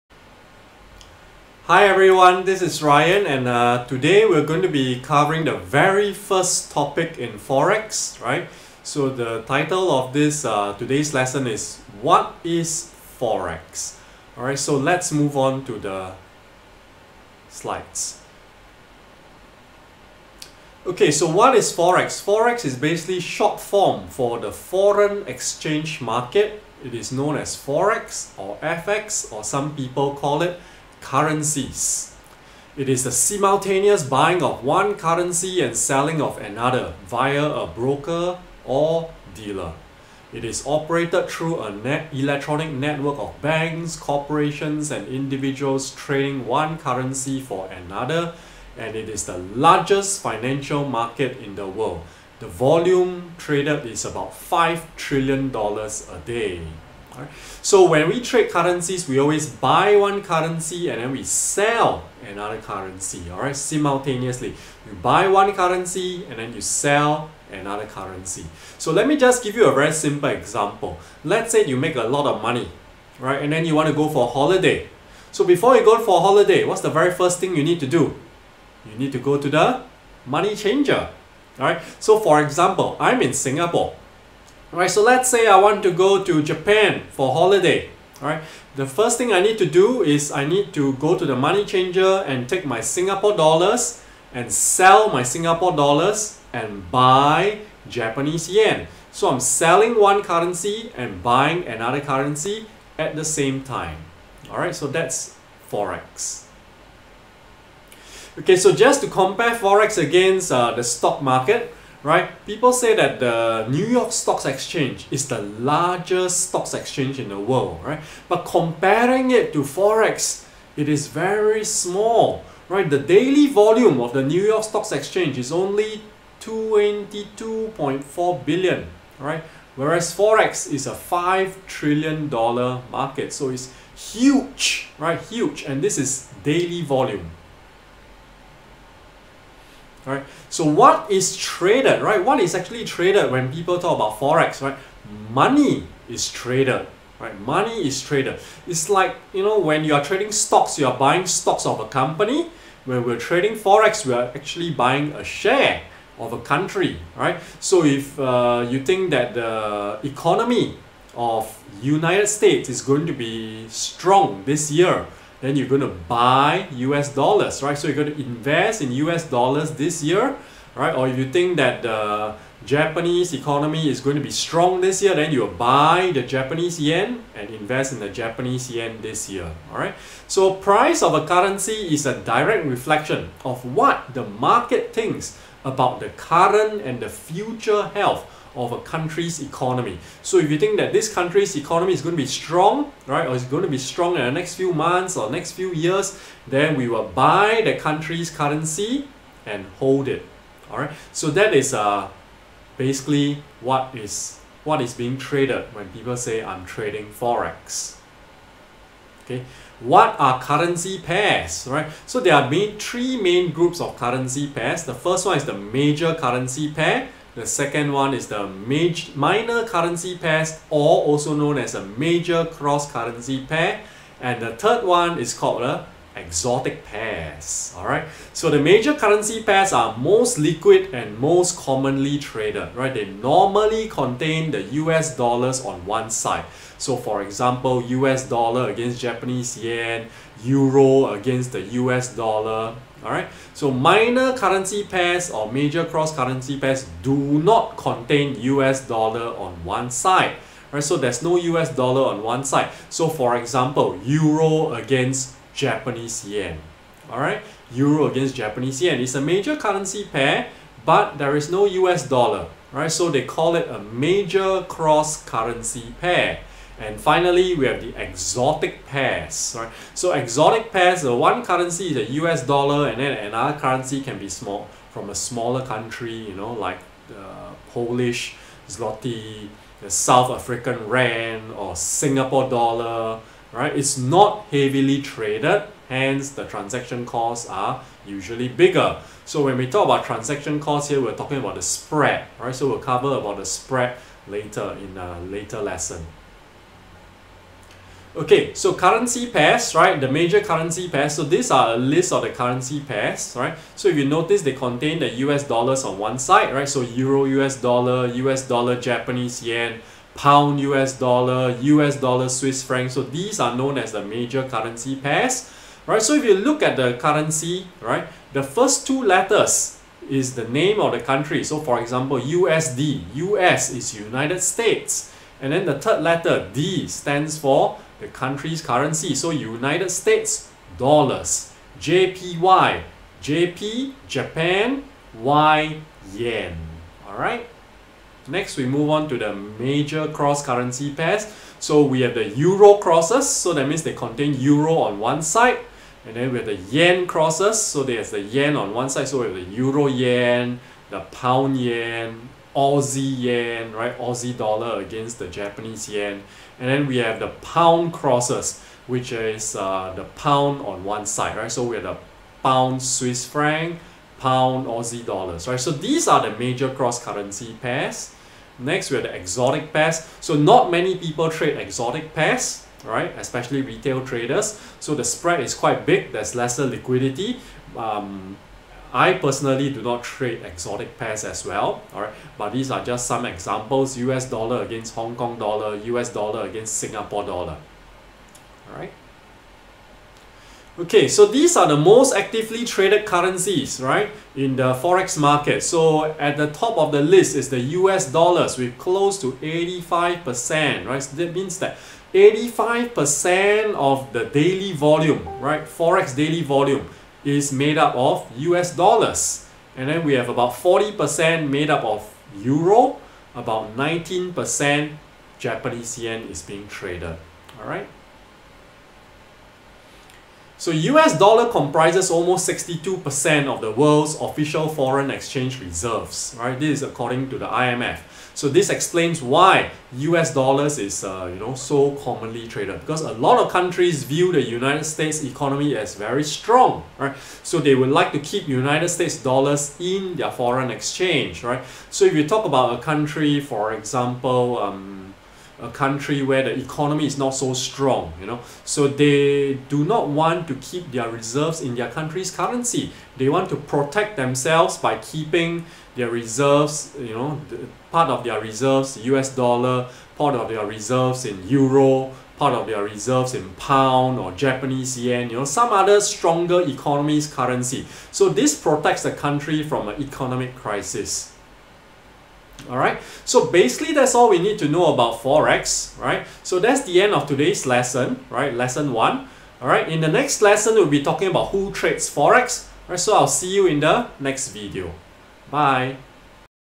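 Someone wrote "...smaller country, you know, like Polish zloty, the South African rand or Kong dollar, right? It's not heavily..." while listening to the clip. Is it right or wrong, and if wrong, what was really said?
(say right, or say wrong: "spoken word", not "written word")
wrong: "Singapore", not "Kong".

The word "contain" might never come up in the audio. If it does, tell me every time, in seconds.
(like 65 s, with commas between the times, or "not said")
233 s, 247 s, 304 s, 343 s.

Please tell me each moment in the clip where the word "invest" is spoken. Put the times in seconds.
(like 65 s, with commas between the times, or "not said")
168 s, 177 s.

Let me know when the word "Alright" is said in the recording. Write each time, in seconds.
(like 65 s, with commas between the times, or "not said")
14 s, 472 s, 479 s.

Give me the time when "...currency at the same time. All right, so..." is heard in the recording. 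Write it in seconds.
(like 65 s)
101 s.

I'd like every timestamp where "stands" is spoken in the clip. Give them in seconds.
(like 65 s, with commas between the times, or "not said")
326 s.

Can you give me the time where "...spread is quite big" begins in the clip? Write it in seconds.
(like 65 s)
375 s.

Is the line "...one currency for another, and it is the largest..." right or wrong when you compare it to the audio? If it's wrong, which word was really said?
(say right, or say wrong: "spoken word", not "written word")
right.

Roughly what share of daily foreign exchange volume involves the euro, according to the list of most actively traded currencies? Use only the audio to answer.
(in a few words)
40%.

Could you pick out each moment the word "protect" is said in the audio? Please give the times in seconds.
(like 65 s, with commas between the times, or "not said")
453 s, 468 s.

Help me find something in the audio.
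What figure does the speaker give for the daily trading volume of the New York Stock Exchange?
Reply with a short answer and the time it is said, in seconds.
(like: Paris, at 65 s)
22.4 billion, at 126 s.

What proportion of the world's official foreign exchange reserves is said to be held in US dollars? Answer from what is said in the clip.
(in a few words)
62%.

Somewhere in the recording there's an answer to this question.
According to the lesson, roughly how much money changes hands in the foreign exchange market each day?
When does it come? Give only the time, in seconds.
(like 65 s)
54 s.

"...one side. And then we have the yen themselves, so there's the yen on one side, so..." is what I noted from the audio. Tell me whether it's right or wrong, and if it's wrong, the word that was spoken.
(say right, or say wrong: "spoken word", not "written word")
wrong: "crosses", not "themselves".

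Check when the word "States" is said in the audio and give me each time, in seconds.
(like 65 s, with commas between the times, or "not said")
162 s, 324 s, 329 s, 434 s, 438 s.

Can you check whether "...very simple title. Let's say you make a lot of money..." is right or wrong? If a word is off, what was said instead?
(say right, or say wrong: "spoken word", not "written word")
wrong: "example", not "title".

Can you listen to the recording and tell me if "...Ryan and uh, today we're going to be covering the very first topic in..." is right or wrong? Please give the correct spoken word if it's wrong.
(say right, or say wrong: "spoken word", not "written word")
right.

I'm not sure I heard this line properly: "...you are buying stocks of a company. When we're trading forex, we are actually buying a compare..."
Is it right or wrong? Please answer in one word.
wrong.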